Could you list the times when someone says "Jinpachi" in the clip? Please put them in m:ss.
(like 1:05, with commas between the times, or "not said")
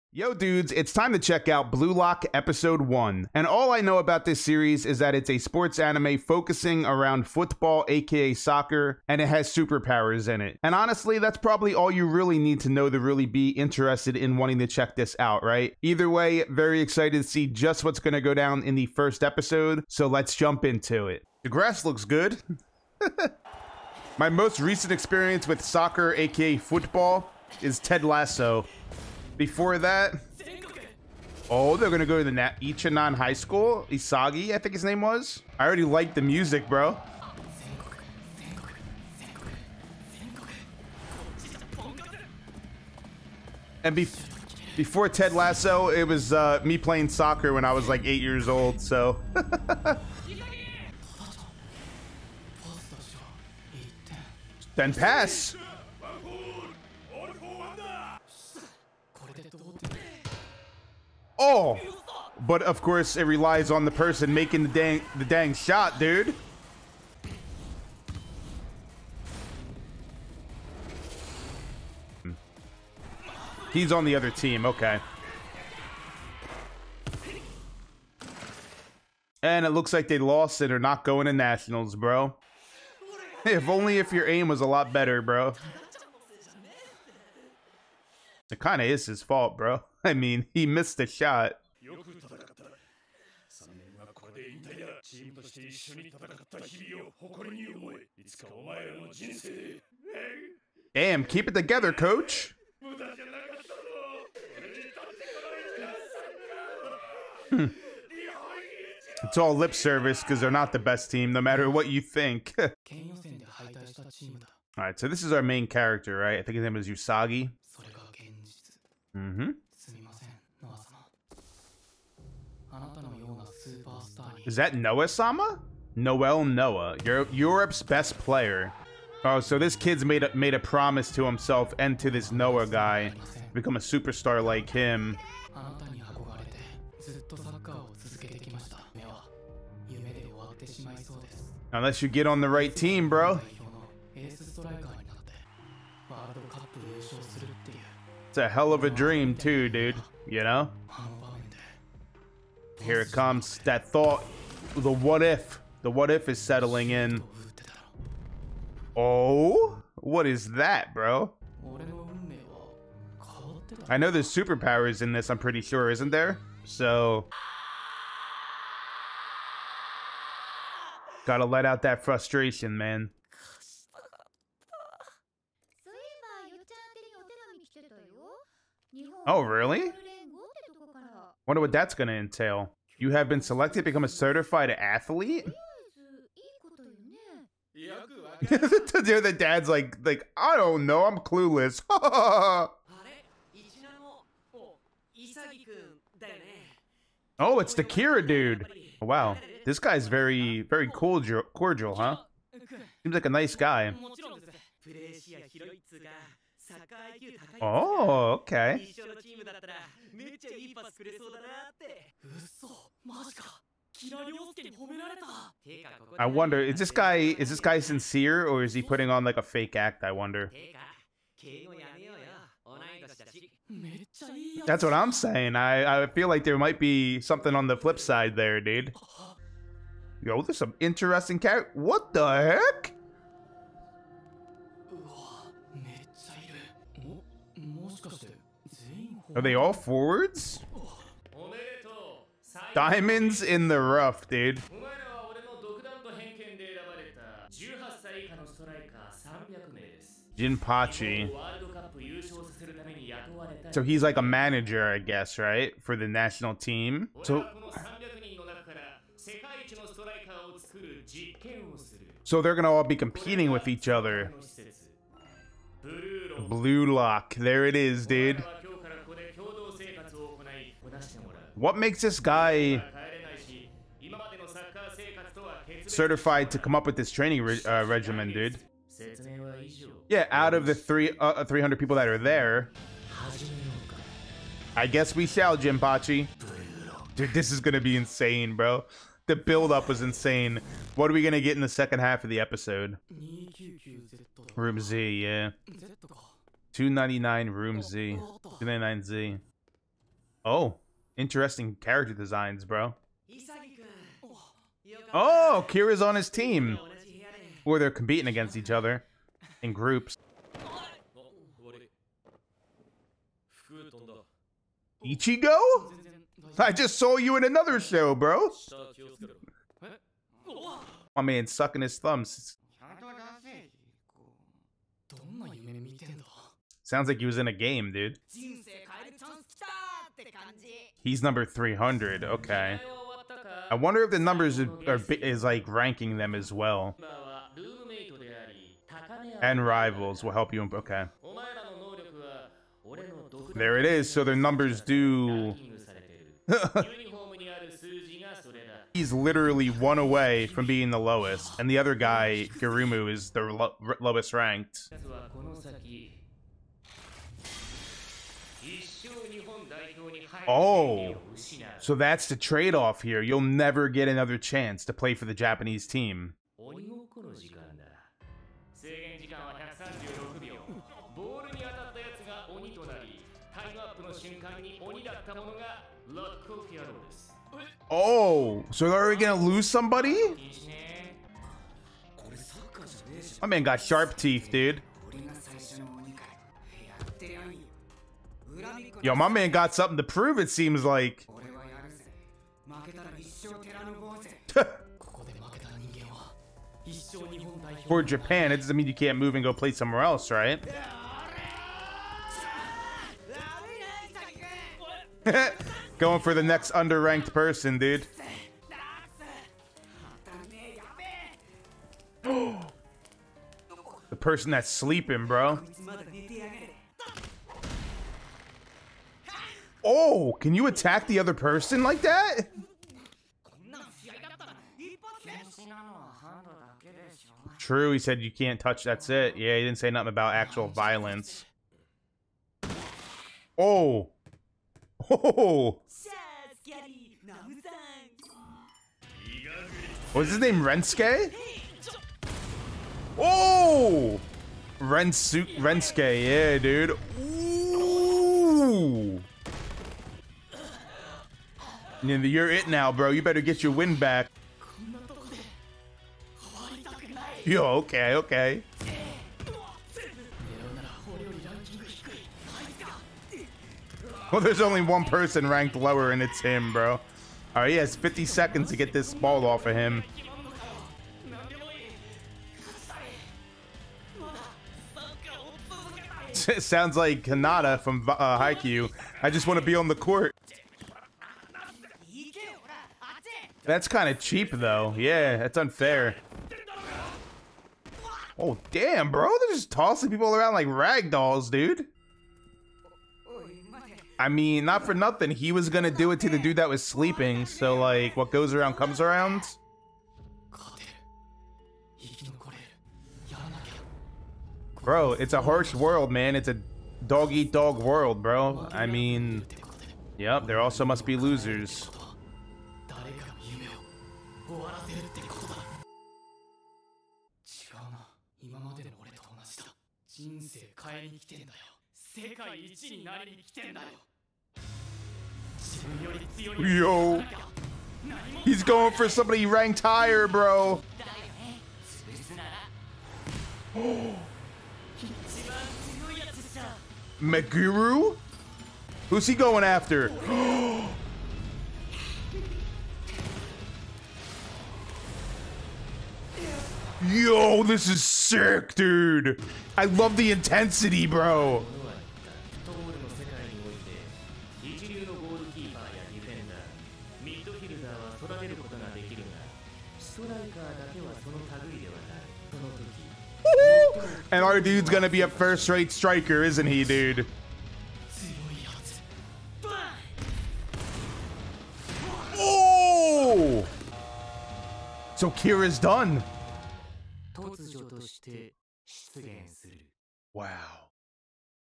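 4:10, 4:45.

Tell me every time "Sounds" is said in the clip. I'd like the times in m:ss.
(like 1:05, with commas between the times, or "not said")
5:26, 7:56.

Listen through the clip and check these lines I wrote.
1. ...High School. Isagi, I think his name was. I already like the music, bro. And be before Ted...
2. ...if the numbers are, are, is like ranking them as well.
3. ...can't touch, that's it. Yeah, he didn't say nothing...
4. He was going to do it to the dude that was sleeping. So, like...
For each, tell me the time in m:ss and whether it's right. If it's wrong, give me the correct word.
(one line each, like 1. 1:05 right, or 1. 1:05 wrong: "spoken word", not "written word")
1. 0:33 right
2. 5:34 right
3. 7:08 right
4. 8:15 right.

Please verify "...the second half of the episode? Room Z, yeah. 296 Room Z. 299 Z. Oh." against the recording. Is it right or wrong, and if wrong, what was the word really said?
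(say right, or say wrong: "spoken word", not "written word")
wrong: "299", not "296".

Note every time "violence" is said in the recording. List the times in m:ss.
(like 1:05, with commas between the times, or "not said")
7:10.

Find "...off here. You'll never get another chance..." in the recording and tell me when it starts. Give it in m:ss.
6:02.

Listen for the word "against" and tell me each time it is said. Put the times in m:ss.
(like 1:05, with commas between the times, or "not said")
5:08.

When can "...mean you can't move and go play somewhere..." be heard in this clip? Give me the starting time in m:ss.
6:38.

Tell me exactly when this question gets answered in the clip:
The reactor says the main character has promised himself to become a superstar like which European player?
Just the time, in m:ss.
2:05.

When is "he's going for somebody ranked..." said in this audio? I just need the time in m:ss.
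8:48.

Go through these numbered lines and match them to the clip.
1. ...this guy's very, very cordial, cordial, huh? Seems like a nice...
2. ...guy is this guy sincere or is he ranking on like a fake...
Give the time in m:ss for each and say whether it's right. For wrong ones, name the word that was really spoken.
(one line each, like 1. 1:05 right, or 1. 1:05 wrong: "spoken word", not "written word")
1. 3:19 right
2. 3:36 wrong: "putting", not "ranking".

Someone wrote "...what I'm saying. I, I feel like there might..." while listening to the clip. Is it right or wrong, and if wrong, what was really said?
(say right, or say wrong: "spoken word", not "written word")
right.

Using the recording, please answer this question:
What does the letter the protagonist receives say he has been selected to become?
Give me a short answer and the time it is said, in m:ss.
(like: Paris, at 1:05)
a certified athlete, at 3:04.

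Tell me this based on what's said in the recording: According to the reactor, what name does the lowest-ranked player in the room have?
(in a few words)
Garumu.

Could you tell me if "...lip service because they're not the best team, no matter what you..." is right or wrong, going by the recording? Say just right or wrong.
right.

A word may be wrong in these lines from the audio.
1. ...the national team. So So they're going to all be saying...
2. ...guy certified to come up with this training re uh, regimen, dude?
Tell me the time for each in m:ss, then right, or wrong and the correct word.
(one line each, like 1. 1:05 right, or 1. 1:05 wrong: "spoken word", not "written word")
1. 4:15 wrong: "competing", not "saying"
2. 4:32 right.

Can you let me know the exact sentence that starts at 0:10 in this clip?
And honestly, that's probably all you really need to know to really be interested in wanting to check this out, right?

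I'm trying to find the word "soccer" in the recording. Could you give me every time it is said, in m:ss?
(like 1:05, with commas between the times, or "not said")
0:08, 0:25, 0:47.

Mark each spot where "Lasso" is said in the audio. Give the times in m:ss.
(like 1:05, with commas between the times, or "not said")
0:28, 0:45.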